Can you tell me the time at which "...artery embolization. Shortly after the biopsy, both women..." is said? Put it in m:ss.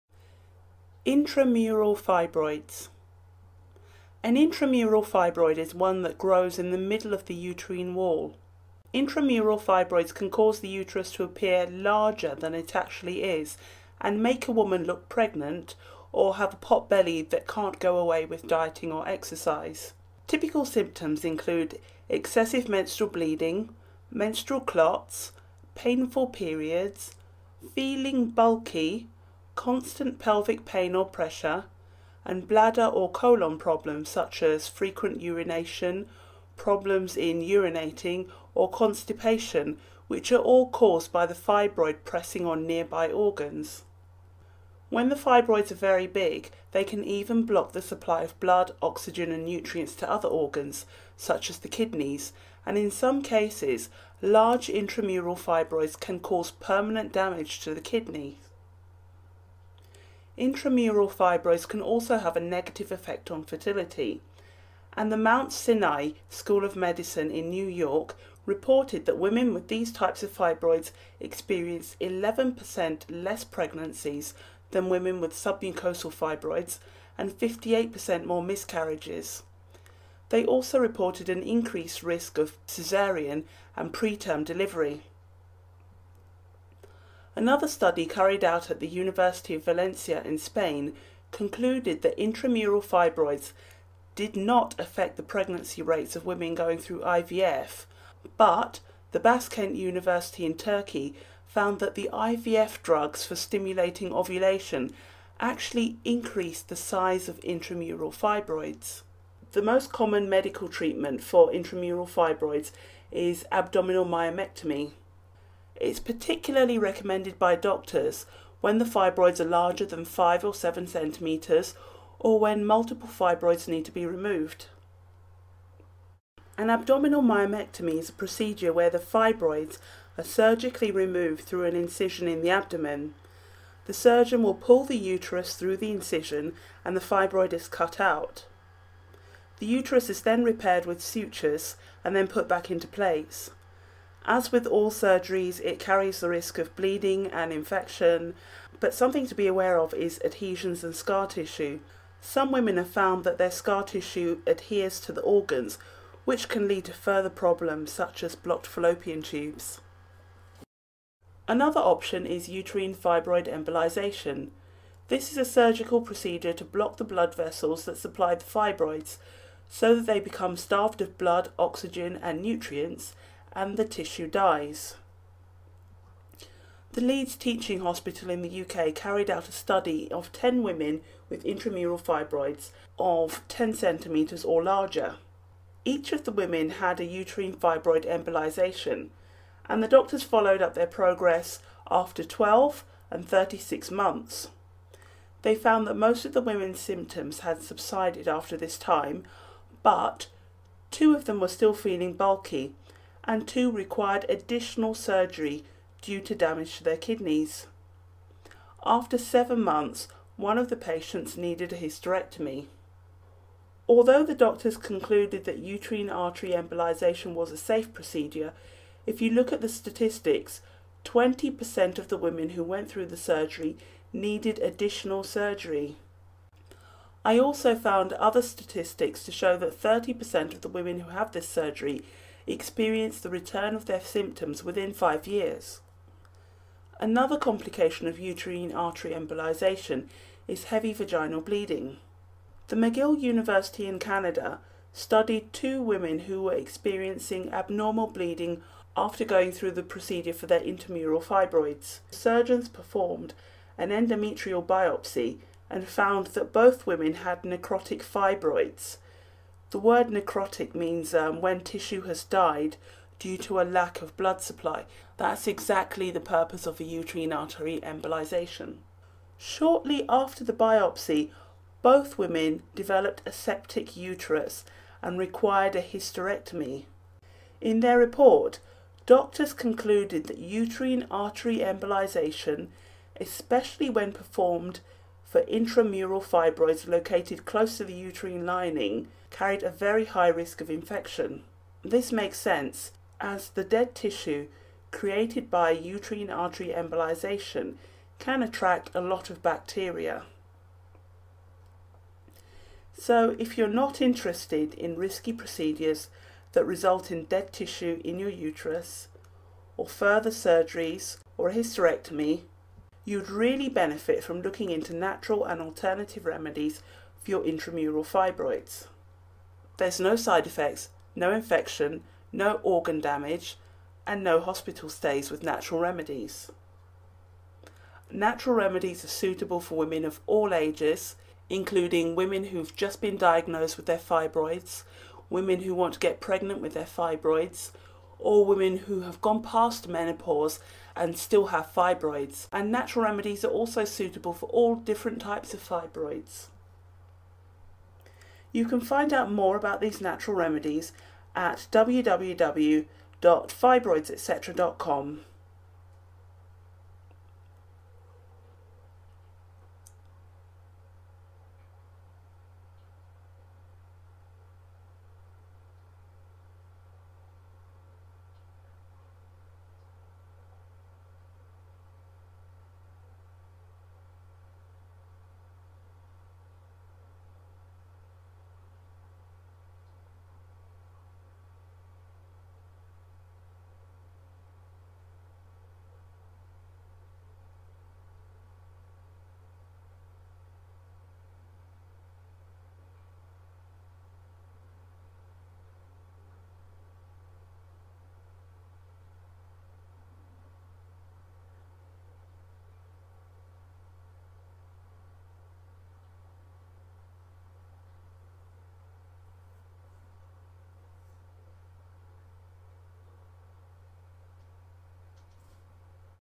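4:27.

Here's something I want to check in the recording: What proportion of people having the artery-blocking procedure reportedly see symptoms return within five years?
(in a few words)
30%.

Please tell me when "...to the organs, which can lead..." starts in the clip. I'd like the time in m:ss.
2:35.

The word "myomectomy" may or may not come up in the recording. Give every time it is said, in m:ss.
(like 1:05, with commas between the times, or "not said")
1:54, 2:07.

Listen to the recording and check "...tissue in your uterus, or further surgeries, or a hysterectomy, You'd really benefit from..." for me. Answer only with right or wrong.
right.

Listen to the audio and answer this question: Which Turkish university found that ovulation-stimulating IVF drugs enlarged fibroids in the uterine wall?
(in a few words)
Baskent University.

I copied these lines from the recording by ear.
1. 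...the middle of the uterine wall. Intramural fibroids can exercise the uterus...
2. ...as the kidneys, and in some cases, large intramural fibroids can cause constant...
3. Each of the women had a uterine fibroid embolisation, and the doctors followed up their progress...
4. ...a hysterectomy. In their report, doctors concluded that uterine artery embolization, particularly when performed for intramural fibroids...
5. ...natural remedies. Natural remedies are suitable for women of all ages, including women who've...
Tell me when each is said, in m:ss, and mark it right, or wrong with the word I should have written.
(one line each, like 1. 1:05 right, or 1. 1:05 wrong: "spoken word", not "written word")
1. 0:06 wrong: "cause", not "exercise"
2. 0:51 wrong: "permanent", not "constant"
3. 3:05 right
4. 4:35 wrong: "especially", not "particularly"
5. 5:25 right.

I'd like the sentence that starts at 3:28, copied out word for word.
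After seven months, one of the patients needed a hysterectomy.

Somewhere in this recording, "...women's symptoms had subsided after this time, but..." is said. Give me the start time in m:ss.
3:16.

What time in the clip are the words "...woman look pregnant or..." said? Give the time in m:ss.
0:14.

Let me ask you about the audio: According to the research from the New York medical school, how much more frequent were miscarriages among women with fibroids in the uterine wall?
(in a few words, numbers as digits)
58%.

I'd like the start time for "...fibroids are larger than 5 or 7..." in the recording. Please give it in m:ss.
1:58.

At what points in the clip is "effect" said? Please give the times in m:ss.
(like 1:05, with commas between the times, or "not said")
1:02, 5:20.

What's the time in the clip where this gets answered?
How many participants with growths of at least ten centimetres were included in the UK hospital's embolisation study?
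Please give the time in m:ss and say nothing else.
3:00.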